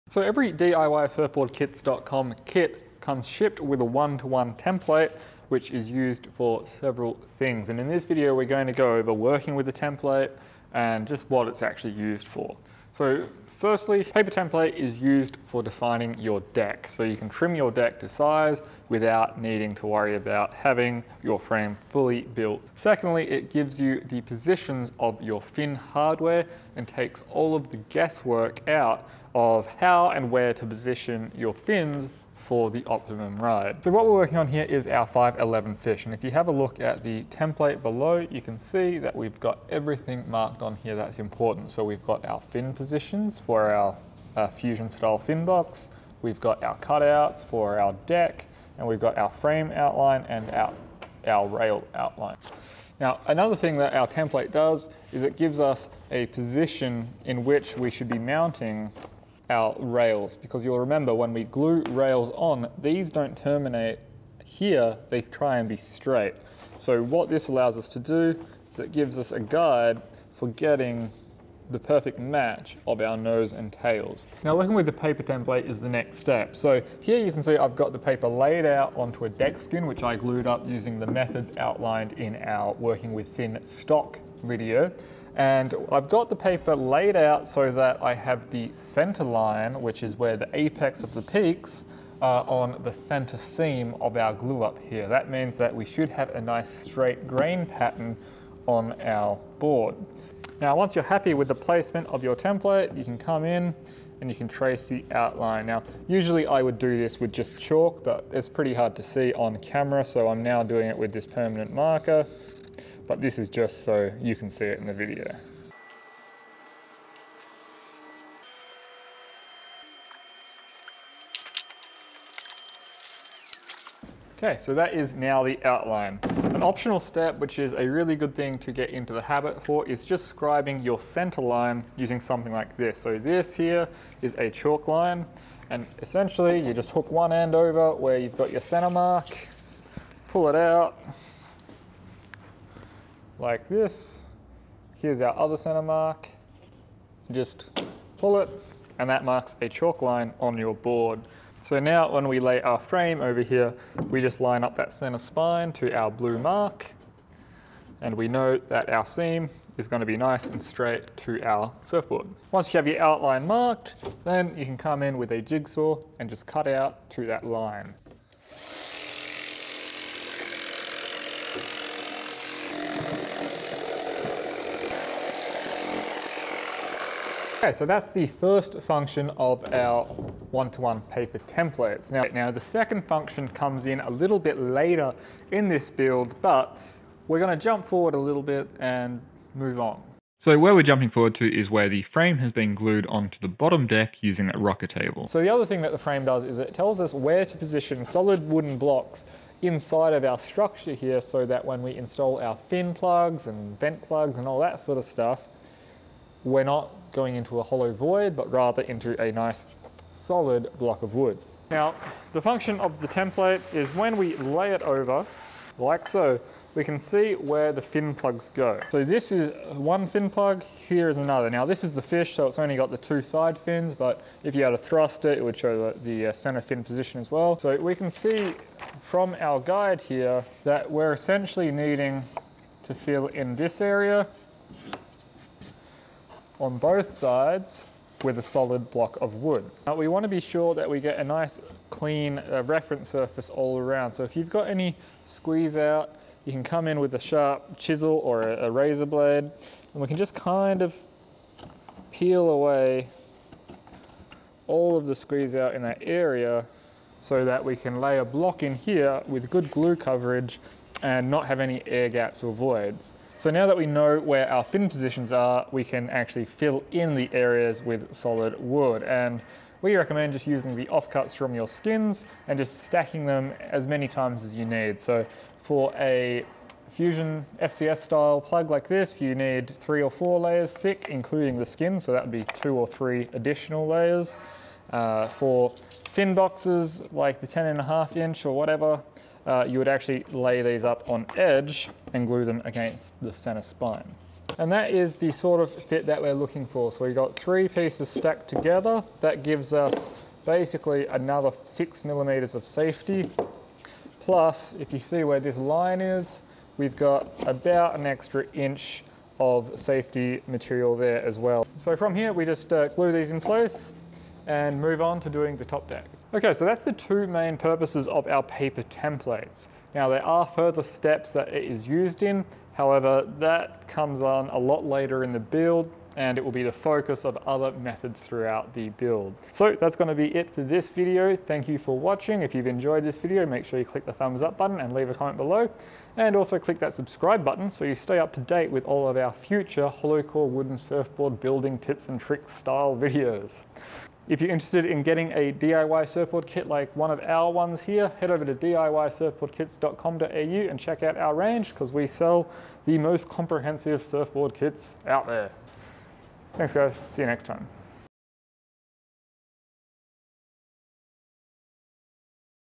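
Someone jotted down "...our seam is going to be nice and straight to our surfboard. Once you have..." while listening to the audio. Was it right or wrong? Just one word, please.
right.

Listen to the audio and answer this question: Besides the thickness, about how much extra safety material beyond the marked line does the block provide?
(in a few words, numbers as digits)
about an extra inch.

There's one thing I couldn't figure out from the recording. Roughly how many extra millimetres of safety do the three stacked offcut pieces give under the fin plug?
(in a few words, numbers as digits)
6 millimetres.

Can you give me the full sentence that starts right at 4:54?
And that is the sort of fit that we're looking for.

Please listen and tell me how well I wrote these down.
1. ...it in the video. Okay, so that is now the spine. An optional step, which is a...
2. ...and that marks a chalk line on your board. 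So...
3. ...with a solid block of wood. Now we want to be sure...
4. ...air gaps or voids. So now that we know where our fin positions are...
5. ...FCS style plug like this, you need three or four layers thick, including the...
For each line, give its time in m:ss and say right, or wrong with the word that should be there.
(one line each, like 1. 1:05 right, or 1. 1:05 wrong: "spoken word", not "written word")
1. 1:54 wrong: "outline", not "spine"
2. 2:28 right
3. 3:58 right
4. 4:21 right
5. 4:37 right.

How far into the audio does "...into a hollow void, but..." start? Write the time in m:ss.
3:27.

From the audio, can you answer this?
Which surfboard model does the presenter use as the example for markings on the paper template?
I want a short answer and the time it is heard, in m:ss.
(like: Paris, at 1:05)
511 fish, at 0:35.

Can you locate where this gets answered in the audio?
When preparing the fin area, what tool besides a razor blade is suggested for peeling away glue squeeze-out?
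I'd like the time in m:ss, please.
4:07.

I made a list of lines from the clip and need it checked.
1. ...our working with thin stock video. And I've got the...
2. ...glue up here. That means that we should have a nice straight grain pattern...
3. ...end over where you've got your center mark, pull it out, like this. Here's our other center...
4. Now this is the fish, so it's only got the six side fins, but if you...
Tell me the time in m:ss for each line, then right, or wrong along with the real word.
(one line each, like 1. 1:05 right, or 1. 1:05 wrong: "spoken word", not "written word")
1. 1:22 right
2. 1:34 right
3. 2:17 right
4. 3:41 wrong: "two", not "six".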